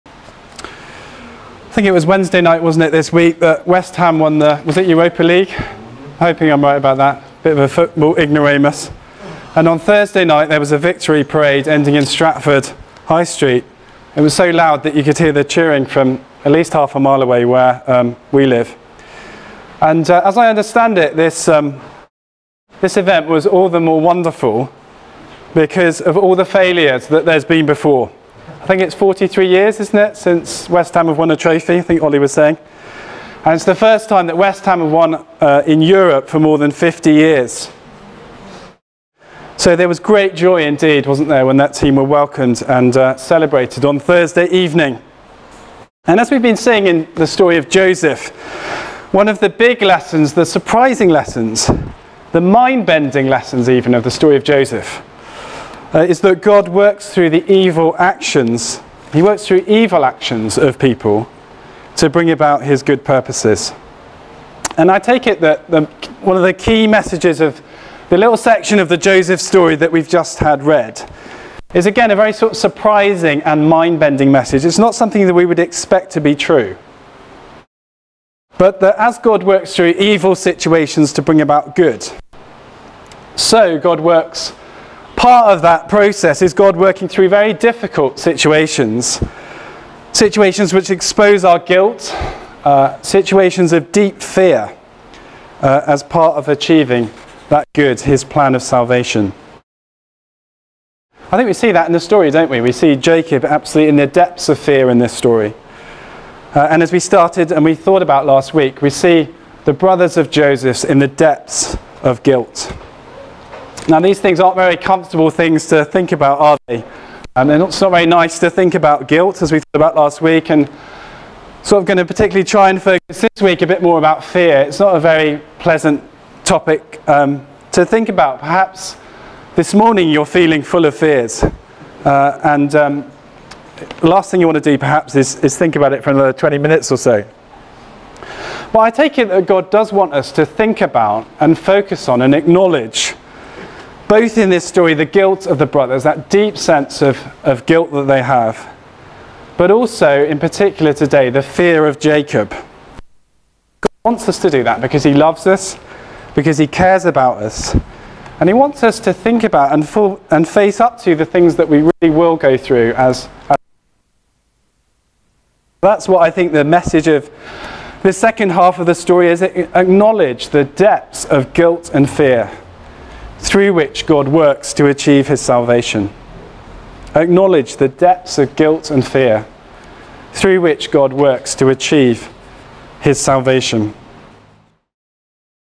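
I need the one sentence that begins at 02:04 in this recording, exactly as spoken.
It's not a very pleasant topic um, to think about.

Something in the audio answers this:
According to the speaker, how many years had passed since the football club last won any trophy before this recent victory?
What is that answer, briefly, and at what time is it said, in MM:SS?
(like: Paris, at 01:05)
43, at 00:28.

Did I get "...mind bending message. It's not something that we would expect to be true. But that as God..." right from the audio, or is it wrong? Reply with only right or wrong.
right.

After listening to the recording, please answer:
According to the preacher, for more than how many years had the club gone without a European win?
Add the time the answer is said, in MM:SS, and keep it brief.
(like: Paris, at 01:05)
50, at 00:36.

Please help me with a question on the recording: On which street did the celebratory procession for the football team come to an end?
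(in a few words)
Stratford High Street.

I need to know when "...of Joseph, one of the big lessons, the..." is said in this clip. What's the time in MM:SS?
00:47.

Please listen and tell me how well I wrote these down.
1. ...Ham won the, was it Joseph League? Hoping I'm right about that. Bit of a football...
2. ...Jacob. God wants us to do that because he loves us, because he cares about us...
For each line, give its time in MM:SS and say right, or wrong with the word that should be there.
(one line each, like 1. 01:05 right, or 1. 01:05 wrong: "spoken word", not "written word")
1. 00:03 wrong: "Europa", not "Joseph"
2. 02:31 right.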